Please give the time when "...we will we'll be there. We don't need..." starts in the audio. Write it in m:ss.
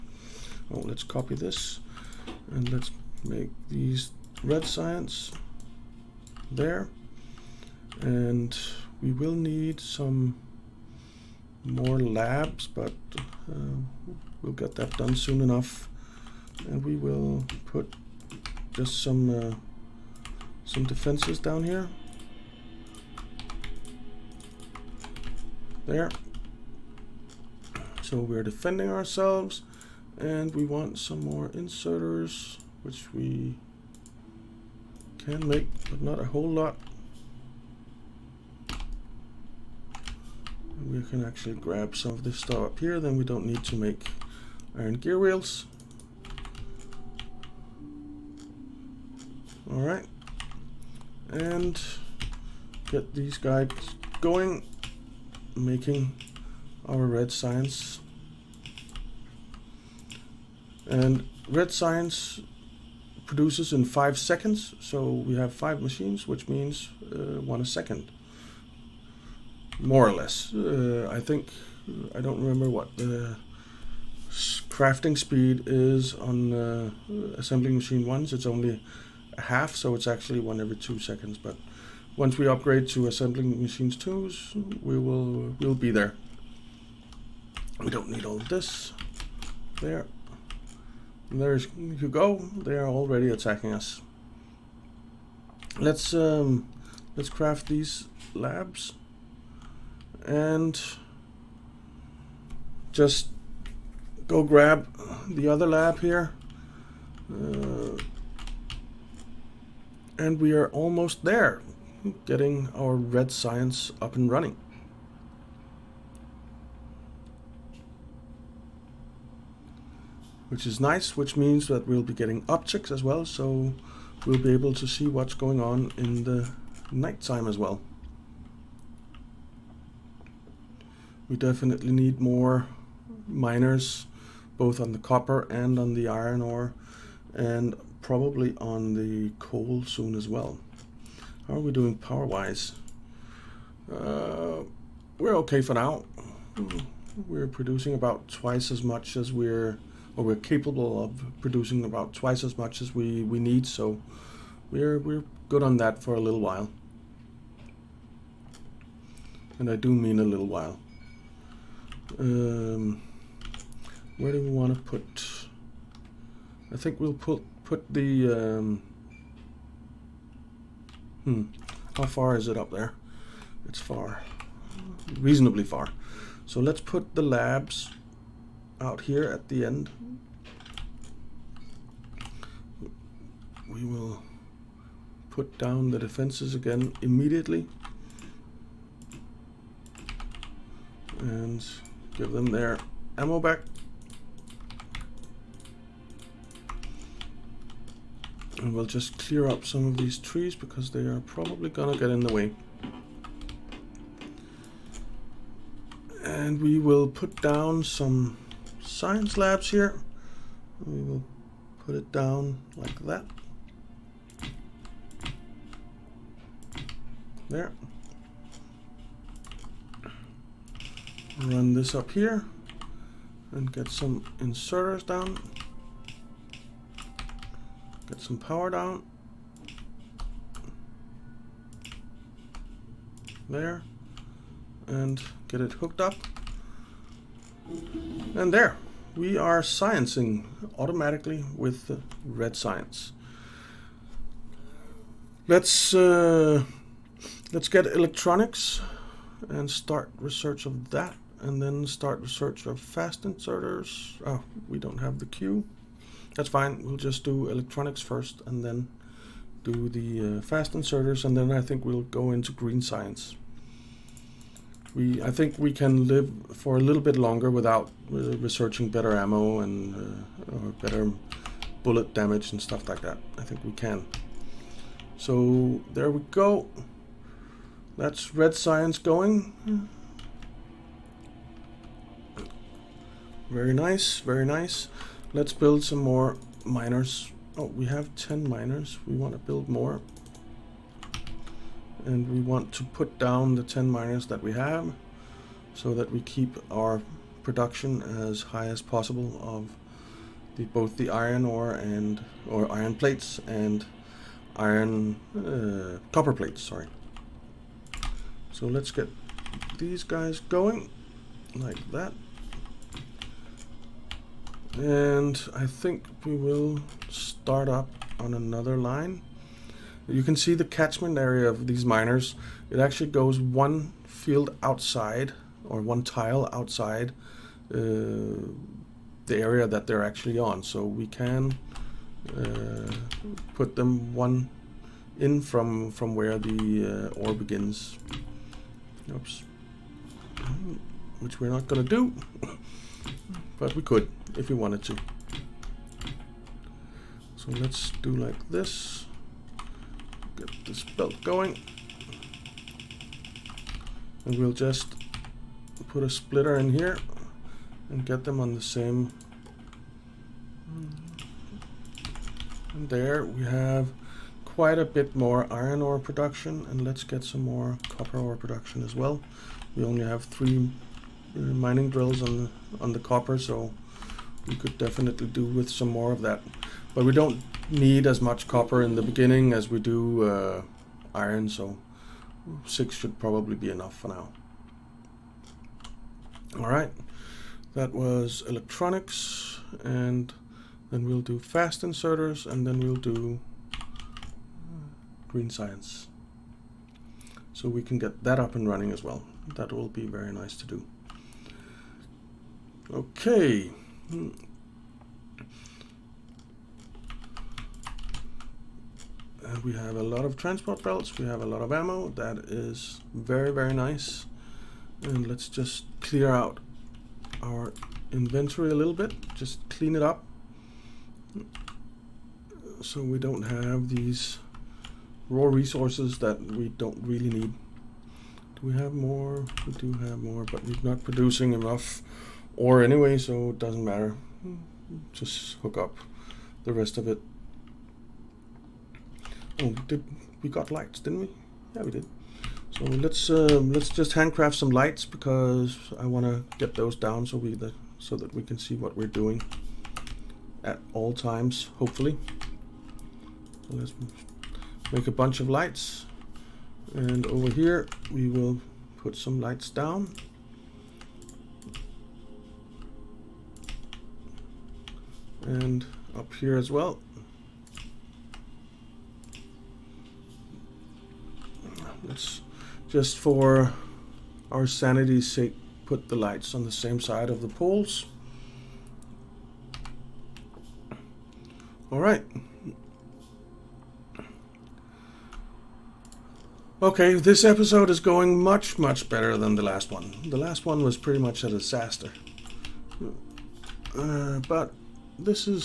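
1:24.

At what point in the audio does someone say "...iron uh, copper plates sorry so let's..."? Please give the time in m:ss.
5:04.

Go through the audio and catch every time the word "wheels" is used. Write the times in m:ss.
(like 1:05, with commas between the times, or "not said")
0:45.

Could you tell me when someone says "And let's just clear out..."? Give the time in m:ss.
6:55.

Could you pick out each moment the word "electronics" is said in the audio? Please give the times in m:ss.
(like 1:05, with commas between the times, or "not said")
4:07, 4:17, 6:28.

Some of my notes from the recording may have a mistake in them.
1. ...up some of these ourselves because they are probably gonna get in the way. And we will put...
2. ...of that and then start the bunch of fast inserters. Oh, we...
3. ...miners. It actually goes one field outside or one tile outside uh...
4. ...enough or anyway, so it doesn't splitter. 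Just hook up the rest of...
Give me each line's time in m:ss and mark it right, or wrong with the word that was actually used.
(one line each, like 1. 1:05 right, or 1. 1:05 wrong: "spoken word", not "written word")
1. 3:19 wrong: "trees", not "ourselves"
2. 4:10 wrong: "search", not "bunch"
3. 5:21 right
4. 7:11 wrong: "matter", not "splitter".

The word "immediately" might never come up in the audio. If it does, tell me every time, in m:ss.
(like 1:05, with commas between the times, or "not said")
3:07.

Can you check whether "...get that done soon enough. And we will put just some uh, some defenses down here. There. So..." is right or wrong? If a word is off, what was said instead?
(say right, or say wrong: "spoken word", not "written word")
right.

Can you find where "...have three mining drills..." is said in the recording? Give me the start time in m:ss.
6:10.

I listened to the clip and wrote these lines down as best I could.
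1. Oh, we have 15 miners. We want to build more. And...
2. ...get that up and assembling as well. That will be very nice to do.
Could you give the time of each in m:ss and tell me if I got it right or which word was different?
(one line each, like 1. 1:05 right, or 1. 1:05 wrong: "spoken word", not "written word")
1. 4:47 wrong: "10", not "15"
2. 6:37 wrong: "running", not "assembling".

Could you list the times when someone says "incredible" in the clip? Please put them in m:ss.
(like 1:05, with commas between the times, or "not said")
not said.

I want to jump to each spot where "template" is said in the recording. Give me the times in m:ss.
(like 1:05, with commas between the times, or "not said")
not said.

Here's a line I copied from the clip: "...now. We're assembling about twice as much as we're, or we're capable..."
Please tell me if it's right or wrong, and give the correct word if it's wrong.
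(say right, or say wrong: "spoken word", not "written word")
wrong: "producing", not "assembling".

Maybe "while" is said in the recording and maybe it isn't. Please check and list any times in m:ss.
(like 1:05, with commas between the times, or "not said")
2:36, 2:40.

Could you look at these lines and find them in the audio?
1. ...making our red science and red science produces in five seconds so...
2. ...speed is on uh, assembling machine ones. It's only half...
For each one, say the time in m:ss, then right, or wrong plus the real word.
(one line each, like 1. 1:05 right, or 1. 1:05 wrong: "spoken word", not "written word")
1. 0:55 right
2. 1:15 right.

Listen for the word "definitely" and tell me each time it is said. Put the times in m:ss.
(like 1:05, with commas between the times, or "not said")
2:11, 6:14.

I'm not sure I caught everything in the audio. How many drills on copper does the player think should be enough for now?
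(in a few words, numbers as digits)
6.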